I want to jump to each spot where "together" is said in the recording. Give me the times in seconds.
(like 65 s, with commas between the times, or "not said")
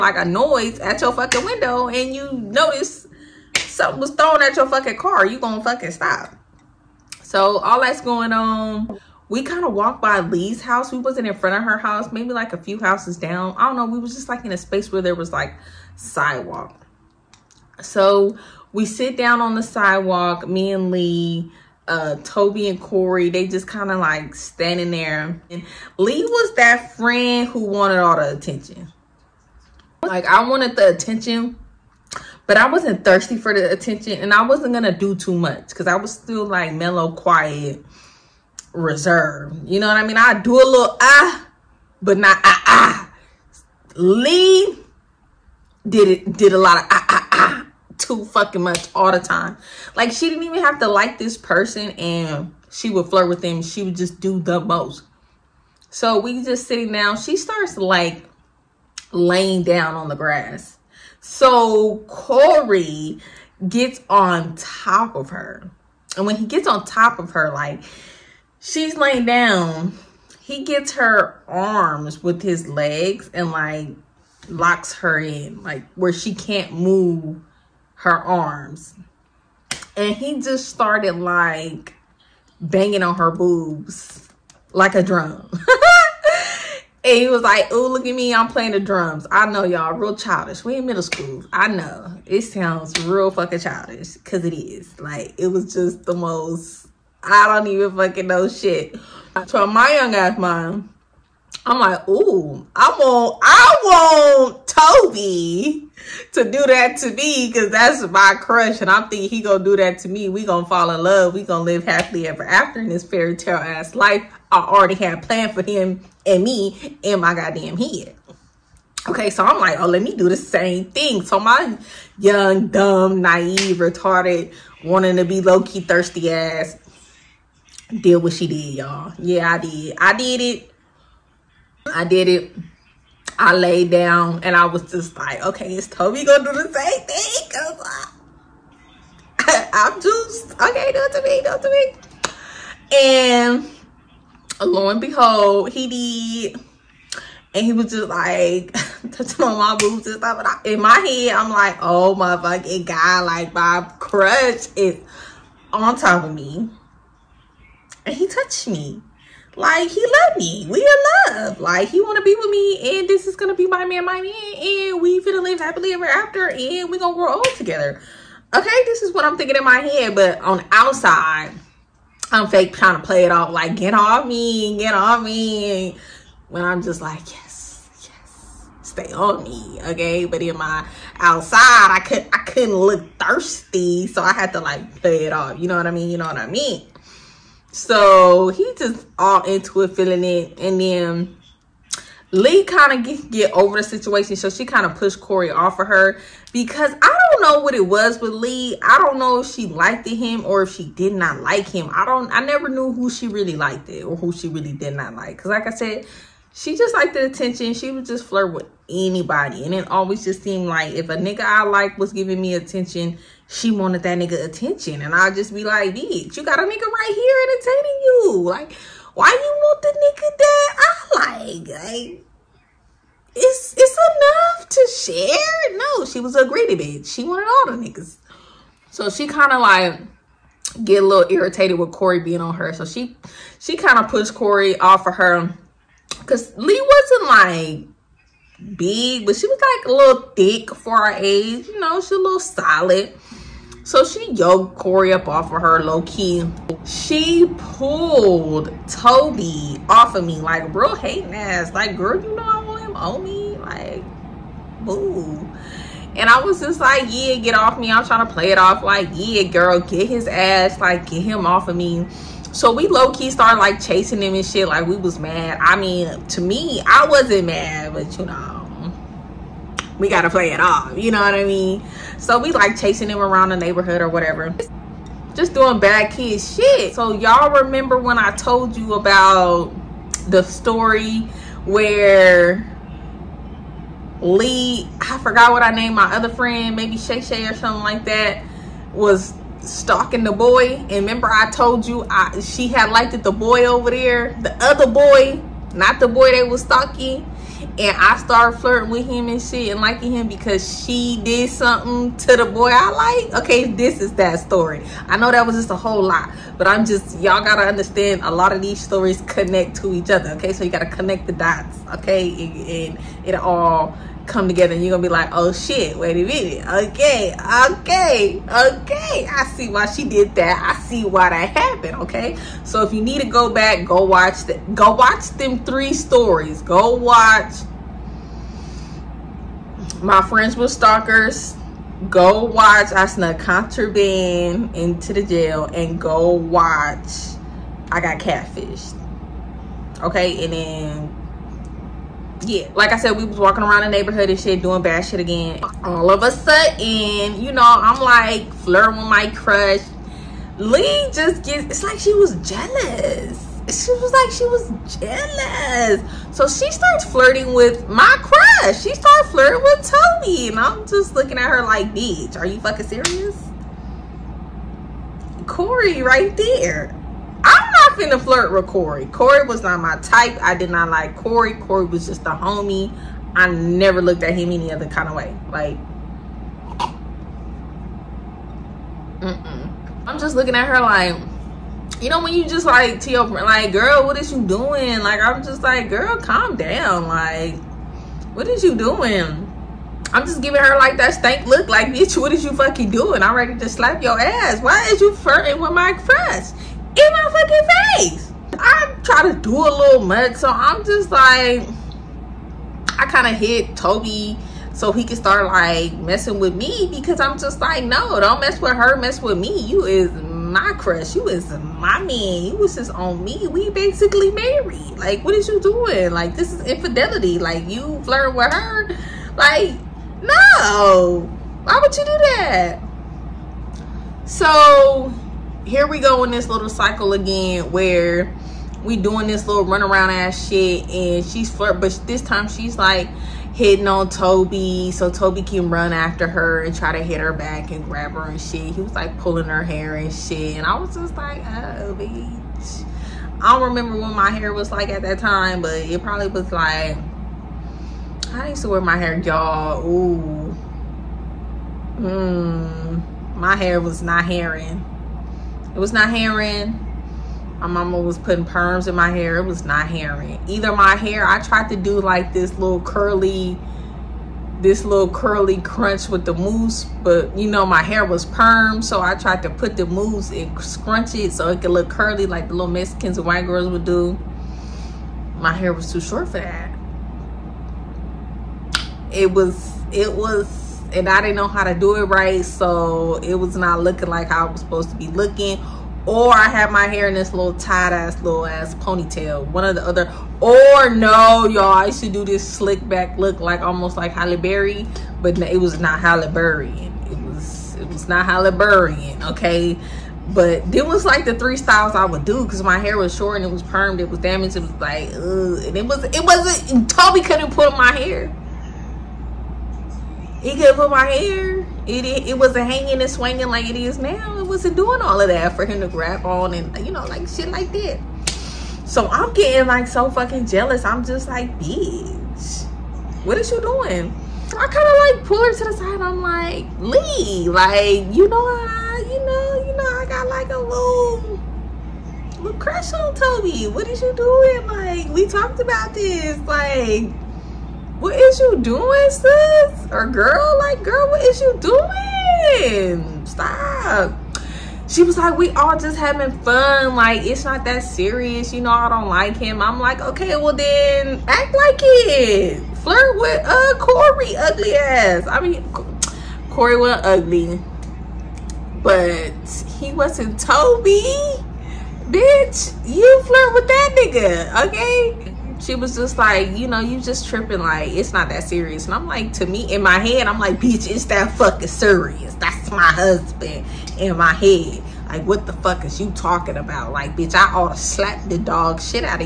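167 s, 314 s.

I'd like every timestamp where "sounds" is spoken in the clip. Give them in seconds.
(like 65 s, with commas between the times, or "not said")
92 s.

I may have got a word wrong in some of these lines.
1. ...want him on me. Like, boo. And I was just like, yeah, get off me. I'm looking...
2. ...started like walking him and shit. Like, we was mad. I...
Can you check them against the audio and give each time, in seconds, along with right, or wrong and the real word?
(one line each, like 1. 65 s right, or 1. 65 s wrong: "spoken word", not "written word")
1. 252 s wrong: "trying", not "looking"
2. 263 s wrong: "chasing", not "walking".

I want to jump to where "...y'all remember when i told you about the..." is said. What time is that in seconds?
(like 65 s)
277 s.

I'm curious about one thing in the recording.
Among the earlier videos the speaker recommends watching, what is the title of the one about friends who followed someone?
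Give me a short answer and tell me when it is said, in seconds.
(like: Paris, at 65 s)
My Friends with Stalkers, at 330 s.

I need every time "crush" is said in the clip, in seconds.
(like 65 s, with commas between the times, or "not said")
108 s, 349 s, 358 s, 395 s, 410 s, 532 s.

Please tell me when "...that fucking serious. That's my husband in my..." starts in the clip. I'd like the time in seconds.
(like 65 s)
571 s.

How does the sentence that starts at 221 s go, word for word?
Like, it's it's enough to share.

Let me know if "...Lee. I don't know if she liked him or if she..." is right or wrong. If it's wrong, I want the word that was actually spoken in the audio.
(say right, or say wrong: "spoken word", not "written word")
right.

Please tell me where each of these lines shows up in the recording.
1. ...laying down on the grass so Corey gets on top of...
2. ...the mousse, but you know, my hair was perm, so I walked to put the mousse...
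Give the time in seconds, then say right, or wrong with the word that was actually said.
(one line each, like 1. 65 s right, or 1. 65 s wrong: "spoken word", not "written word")
1. 59 s right
2. 466 s wrong: "tried", not "walked".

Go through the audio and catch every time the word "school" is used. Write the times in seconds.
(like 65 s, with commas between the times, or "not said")
91 s.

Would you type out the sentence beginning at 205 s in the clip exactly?
Cause like I said, she just liked the attention.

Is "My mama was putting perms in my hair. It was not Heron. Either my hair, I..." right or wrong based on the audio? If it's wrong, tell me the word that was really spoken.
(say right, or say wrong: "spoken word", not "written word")
right.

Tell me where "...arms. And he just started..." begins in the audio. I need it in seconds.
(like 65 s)
78 s.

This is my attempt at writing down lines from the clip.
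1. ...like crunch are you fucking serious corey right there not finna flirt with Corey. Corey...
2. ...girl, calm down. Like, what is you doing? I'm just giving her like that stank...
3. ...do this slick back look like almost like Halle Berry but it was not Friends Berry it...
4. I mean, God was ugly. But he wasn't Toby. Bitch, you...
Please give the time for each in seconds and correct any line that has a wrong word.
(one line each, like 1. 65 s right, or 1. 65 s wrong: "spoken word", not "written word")
1. 361 s wrong: "bitch", not "crunch"
2. 385 s right
3. 492 s wrong: "Halle", not "Friends"
4. 555 s wrong: "Corey", not "God".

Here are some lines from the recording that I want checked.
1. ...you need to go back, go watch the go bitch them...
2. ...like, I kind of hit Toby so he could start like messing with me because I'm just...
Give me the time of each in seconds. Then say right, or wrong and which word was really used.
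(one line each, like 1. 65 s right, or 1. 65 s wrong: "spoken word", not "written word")
1. 322 s wrong: "watch", not "bitch"
2. 401 s right.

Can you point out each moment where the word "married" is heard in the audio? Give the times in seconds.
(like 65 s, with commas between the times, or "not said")
414 s.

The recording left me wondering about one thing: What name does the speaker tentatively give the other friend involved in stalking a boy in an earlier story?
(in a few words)
Shay Shay.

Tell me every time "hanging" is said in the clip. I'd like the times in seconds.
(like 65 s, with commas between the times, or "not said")
512 s.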